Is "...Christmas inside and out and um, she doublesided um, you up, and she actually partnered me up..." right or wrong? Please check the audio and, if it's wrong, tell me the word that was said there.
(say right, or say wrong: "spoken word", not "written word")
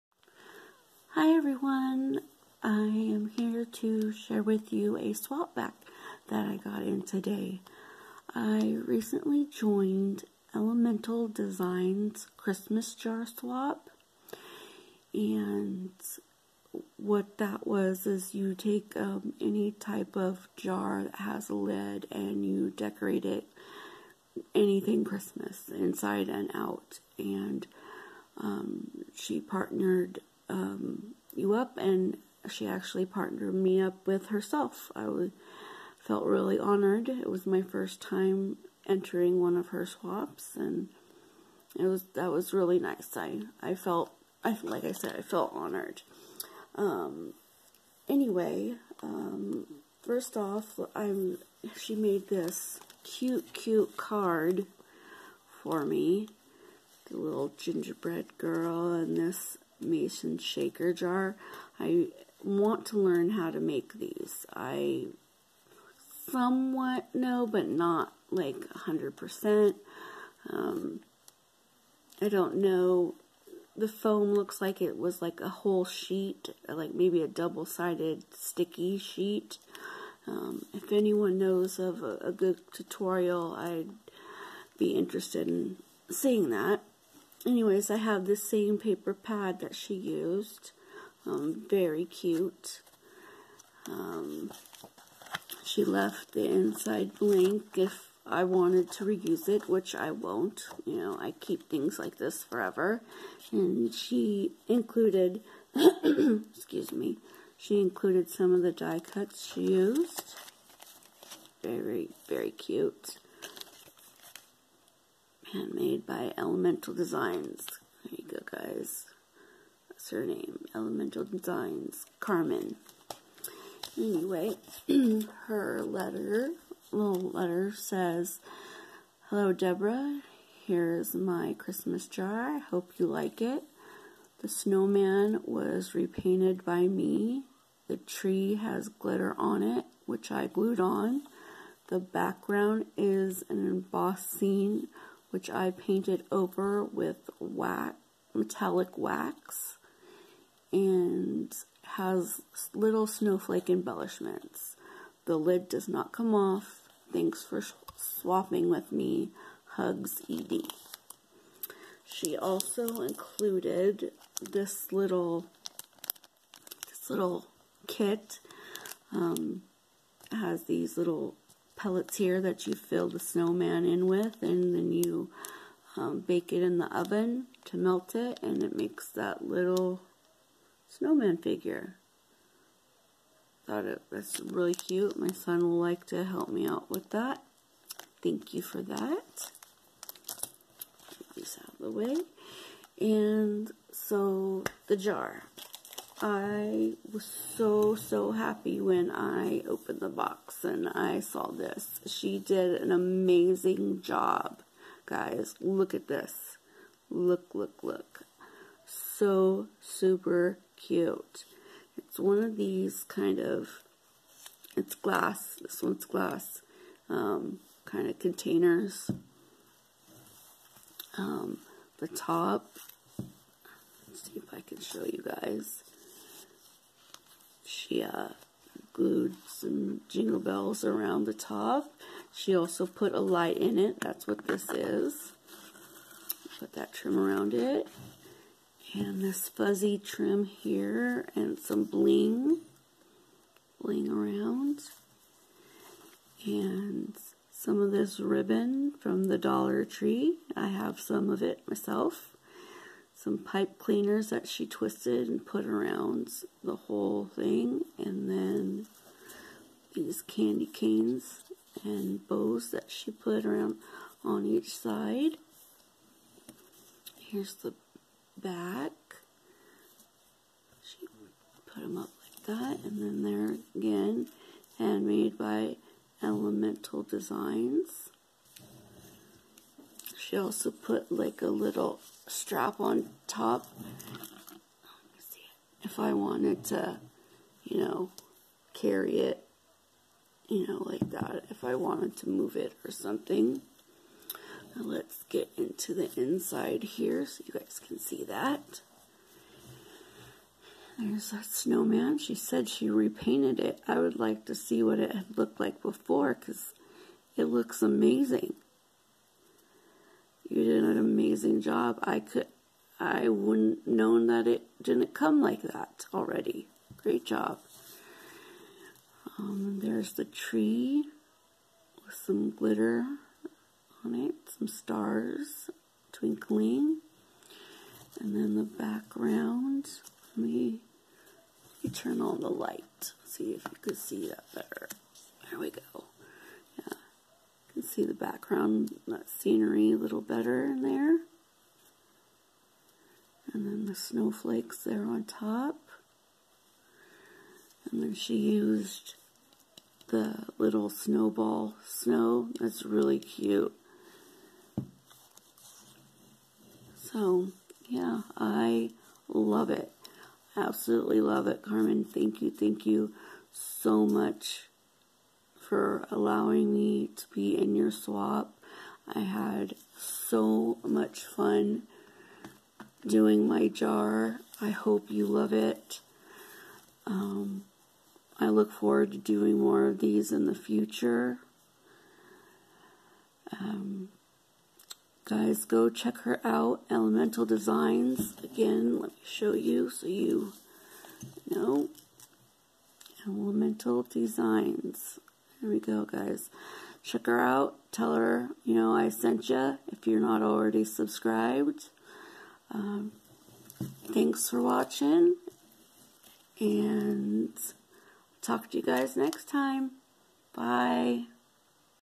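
wrong: "partnered", not "doublesided".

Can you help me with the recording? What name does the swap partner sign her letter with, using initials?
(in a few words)
ED.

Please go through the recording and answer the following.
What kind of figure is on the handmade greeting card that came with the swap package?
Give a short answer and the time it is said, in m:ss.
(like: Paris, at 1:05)
Gingerbread girl, at 0:57.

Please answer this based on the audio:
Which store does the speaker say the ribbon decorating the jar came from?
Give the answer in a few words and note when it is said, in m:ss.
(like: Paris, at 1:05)
Dollar Tree, at 4:09.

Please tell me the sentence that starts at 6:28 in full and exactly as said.
Again, let me show you so you know.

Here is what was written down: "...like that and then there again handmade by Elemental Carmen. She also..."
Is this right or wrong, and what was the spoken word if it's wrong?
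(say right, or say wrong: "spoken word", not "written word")
wrong: "Designs", not "Carmen".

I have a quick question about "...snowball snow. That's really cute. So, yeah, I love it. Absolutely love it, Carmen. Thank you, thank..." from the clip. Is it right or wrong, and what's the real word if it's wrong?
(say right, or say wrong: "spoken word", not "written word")
right.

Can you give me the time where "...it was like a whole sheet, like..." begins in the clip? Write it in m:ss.
1:14.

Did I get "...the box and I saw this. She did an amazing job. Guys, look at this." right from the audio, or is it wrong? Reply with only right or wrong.
right.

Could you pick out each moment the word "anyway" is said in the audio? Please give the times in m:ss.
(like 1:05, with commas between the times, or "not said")
0:48, 1:27, 2:03.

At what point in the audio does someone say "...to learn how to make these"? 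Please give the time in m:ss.
1:02.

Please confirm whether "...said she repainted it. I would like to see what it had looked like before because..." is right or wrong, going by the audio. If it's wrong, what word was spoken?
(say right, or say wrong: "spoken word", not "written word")
right.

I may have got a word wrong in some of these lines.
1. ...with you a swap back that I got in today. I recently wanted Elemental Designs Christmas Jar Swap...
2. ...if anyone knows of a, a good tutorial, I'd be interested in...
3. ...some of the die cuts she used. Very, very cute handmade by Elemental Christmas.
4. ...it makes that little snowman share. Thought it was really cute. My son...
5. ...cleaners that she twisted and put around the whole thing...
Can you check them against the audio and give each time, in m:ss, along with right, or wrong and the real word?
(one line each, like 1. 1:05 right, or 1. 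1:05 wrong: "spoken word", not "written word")
1. 0:04 wrong: "joined", not "wanted"
2. 1:20 right
3. 1:48 wrong: "Designs", not "Christmas"
4. 2:58 wrong: "figure", not "share"
5. 4:13 right.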